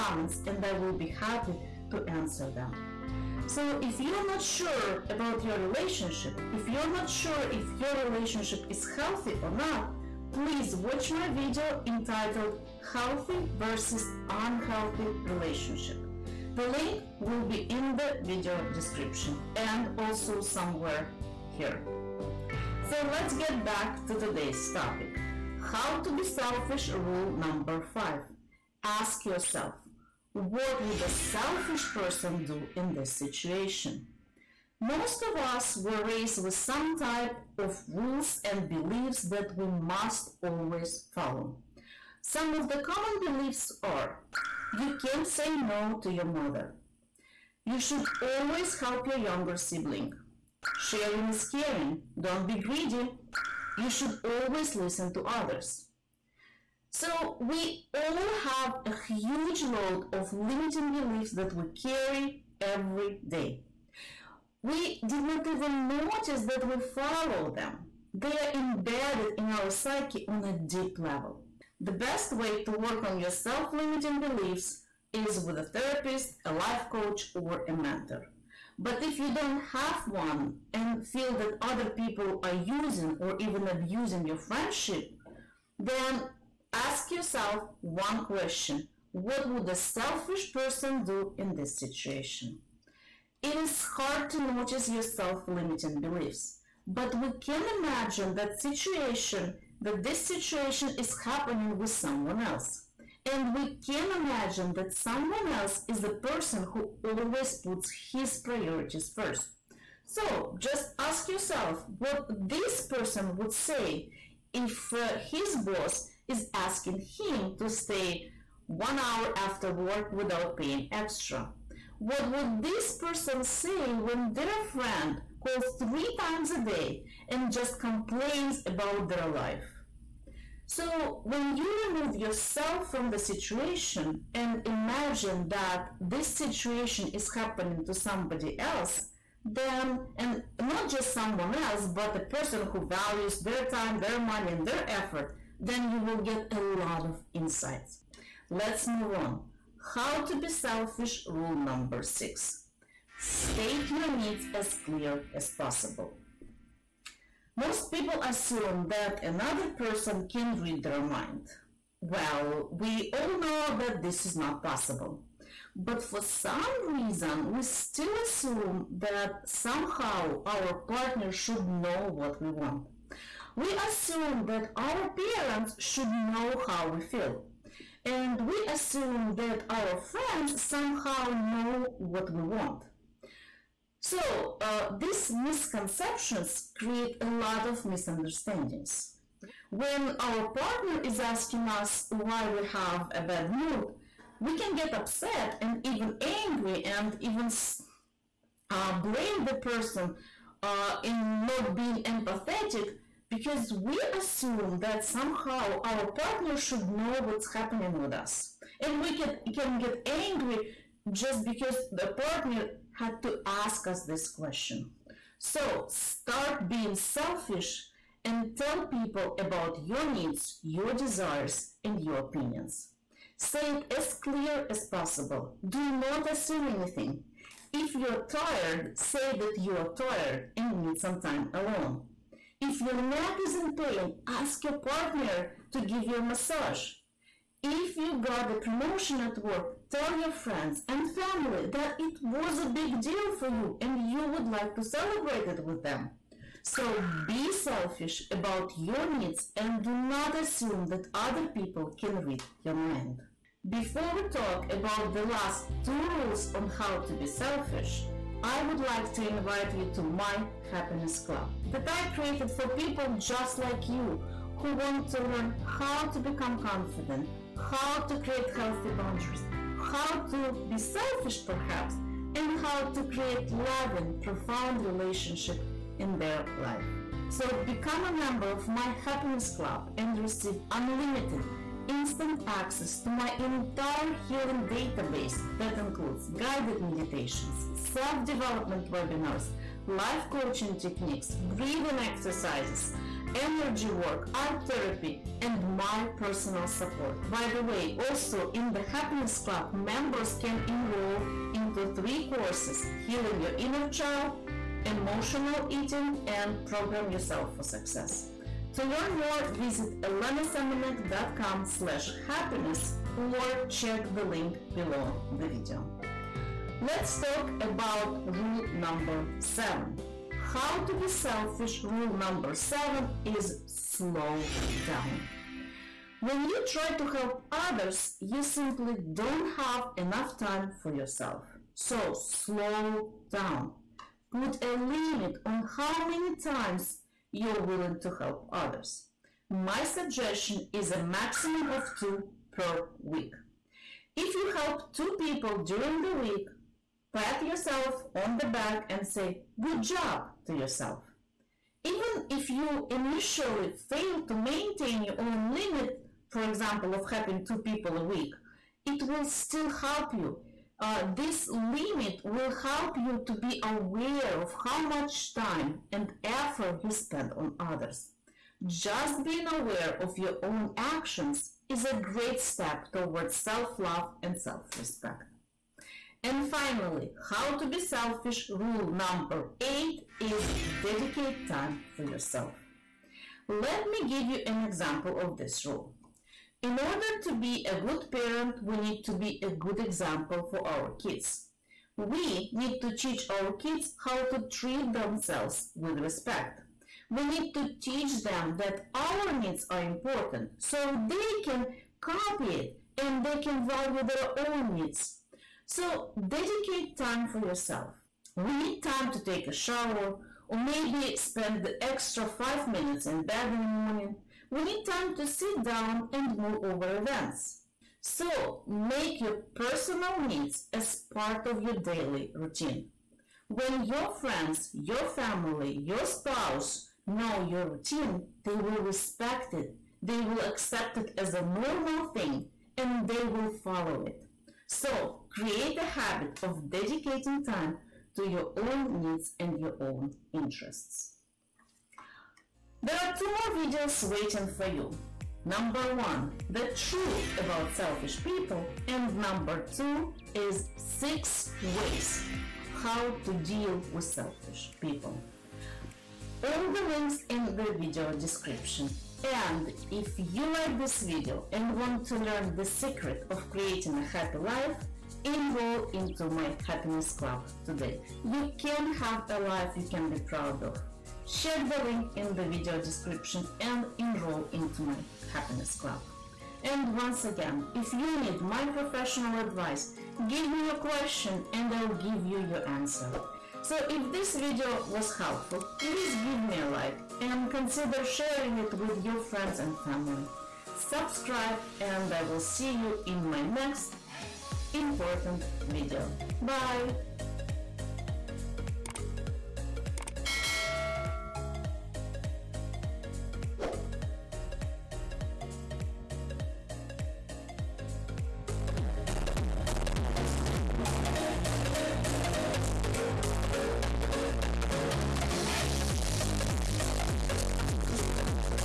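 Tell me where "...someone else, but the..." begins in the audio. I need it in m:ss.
2:21.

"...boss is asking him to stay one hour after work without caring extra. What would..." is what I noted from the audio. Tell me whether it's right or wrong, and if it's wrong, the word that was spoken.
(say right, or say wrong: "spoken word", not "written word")
wrong: "paying", not "caring".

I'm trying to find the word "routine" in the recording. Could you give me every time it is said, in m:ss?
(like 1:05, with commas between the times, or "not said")
7:02, 7:07.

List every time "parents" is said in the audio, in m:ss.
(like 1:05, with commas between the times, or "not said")
2:55, 6:28.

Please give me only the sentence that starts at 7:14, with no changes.
So Create a habit of dedicating time to your own needs and your own interests.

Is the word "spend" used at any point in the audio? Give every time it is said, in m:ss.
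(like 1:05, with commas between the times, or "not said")
6:06, 6:51.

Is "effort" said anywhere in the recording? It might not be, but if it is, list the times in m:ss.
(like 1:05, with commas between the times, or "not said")
2:24, 6:06.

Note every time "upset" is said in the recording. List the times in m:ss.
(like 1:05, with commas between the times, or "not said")
3:14.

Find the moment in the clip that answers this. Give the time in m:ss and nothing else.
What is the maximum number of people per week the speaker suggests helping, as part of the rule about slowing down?
5:40.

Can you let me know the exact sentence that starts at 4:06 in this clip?
So be selfish about your needs and do not assume that other people can read your mind.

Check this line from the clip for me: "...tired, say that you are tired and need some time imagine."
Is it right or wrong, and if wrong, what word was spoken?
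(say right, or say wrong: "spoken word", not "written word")
wrong: "alone", not "imagine".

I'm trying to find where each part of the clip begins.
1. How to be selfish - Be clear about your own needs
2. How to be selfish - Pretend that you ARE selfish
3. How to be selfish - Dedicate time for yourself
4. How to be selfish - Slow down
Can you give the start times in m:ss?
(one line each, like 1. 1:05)
1. 2:29
2. 0:25
3. 6:15
4. 5:20.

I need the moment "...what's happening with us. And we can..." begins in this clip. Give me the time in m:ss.
3:27.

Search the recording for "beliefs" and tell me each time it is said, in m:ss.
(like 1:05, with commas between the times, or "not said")
0:38, 0:43, 1:00, 1:14, 1:36.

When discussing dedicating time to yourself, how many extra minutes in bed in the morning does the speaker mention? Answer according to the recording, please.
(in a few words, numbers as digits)
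5.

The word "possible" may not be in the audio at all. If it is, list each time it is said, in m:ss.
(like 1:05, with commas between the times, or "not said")
2:35, 2:44, 3:44.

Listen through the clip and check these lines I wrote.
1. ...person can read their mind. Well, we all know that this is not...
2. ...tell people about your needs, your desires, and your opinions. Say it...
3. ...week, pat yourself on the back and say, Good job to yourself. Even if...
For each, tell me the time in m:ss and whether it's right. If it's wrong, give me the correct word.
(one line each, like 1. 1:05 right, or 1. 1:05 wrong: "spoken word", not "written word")
1. 2:39 right
2. 3:38 right
3. 5:46 right.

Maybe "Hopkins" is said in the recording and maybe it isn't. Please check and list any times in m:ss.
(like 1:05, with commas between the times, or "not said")
not said.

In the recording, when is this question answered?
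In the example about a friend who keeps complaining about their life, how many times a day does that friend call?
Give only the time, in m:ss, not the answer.
2:05.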